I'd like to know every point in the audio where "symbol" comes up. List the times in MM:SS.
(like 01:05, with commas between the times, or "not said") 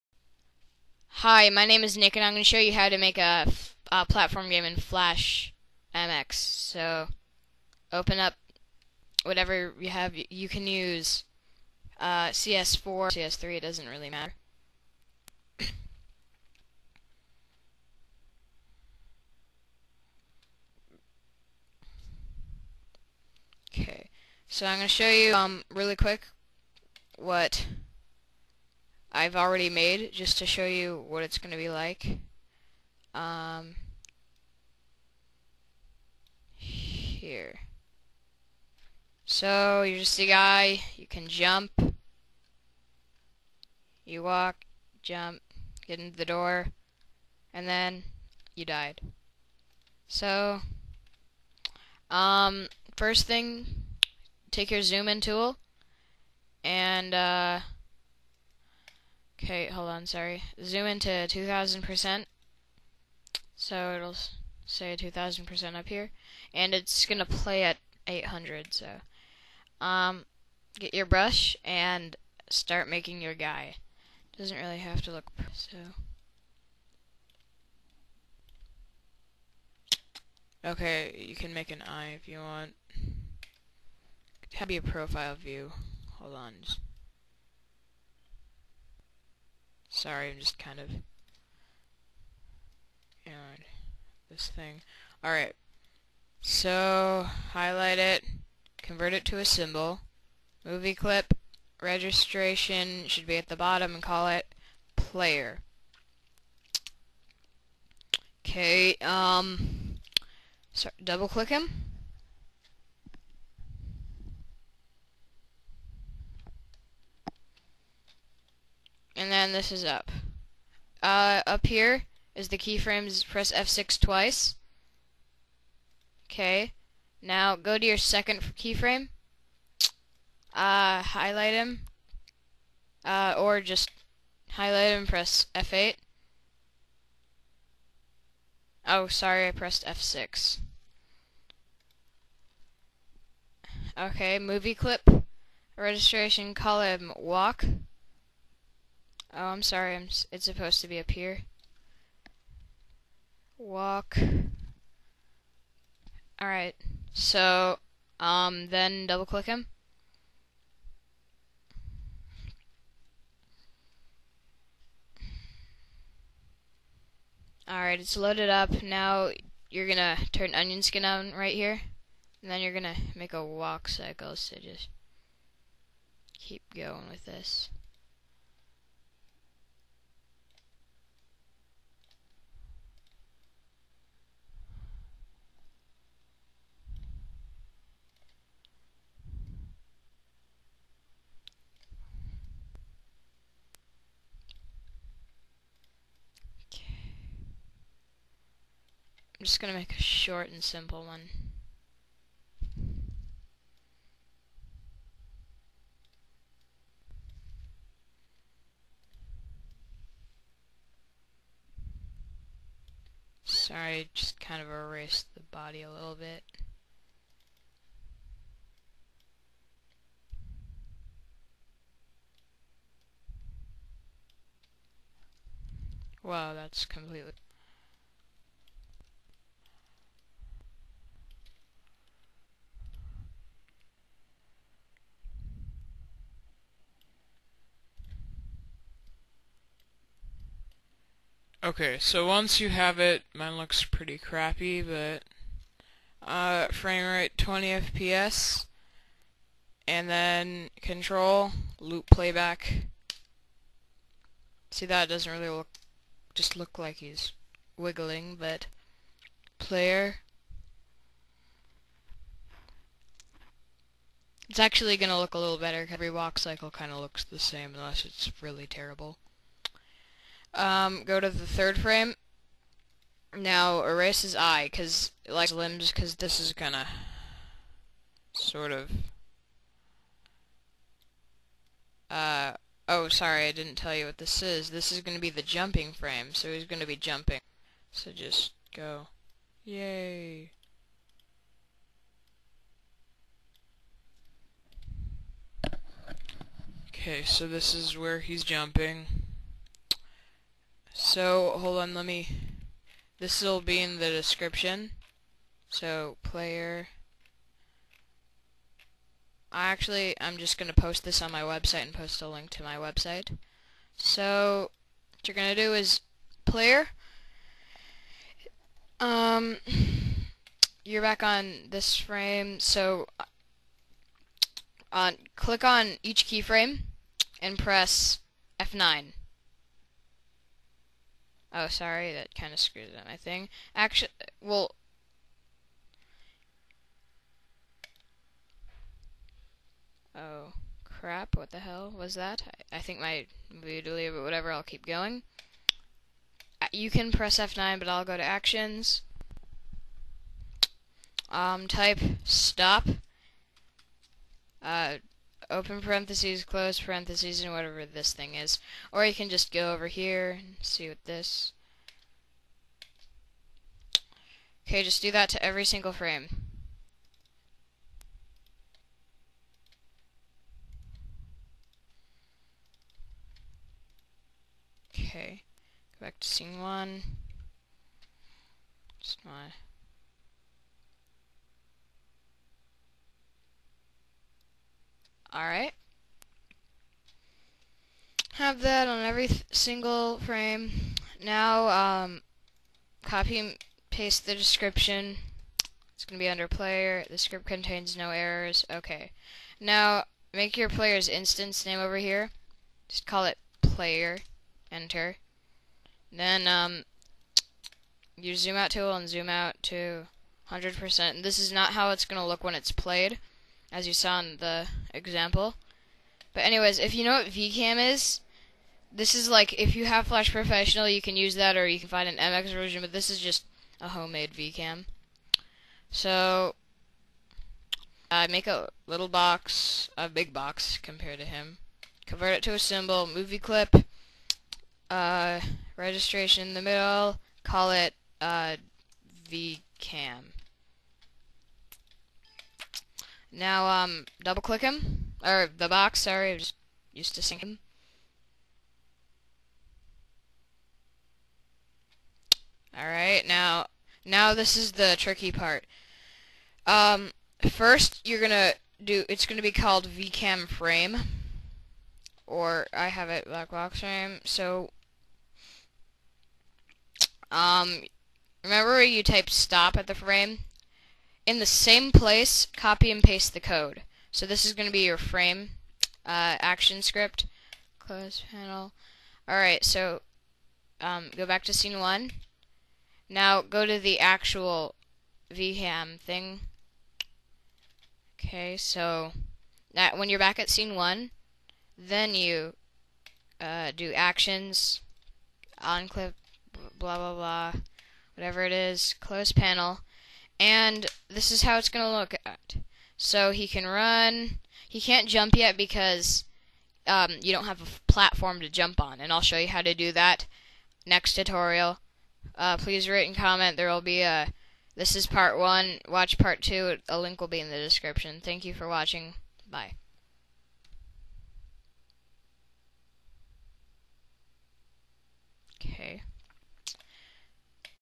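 01:39, 07:12.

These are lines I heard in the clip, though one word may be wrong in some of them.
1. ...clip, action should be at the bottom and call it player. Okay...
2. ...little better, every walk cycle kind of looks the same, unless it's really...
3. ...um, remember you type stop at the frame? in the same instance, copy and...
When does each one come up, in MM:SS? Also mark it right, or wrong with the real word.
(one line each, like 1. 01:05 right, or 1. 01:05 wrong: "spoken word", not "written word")
1. 01:40 wrong: "registration", not "action"
2. 04:25 right
3. 07:47 wrong: "place", not "instance".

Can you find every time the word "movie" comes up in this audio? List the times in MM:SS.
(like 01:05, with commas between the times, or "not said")
01:40, 02:24, 07:13.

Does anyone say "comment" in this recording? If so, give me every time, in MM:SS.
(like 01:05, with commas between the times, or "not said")
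08:33.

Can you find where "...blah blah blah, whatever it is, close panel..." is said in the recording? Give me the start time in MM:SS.
08:16.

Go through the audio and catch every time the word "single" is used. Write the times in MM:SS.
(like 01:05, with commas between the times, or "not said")
06:05, 06:29.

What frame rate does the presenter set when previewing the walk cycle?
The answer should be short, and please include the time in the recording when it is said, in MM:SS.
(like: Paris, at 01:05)
20 FPS, at 04:07.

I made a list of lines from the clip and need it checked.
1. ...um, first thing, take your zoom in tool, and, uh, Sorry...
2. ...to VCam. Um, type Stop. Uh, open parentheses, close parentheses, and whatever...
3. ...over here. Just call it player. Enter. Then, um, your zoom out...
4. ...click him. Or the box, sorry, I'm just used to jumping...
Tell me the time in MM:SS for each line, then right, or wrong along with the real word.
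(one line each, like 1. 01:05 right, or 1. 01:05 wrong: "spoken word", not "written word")
1. 00:52 wrong: "Okay", not "Sorry"
2. 05:48 wrong: "Actions", not "VCam"
3. 06:41 right
4. 07:24 wrong: "seeing", not "jumping".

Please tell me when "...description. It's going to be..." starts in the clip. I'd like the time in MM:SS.
06:34.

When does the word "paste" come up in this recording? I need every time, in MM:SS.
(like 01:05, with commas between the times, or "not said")
06:33, 07:53.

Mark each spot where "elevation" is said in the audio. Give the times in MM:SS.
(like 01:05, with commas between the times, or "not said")
not said.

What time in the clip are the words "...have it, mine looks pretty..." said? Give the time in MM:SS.
04:02.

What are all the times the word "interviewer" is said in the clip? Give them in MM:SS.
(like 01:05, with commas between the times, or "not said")
not said.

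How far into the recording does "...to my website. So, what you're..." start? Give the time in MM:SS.
05:12.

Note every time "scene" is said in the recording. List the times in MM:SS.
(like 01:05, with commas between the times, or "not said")
06:16, 08:01, 08:10.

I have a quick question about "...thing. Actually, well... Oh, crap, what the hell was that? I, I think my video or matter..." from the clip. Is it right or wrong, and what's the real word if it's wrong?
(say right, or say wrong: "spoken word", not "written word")
wrong: "whatever", not "matter".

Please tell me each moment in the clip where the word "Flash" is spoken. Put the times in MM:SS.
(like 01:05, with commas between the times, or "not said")
00:04, 07:00.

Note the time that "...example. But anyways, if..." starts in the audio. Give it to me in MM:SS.
06:54.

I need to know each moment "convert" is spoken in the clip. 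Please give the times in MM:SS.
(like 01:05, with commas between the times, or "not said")
01:38, 07:12.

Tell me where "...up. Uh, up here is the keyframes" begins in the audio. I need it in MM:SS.
01:59.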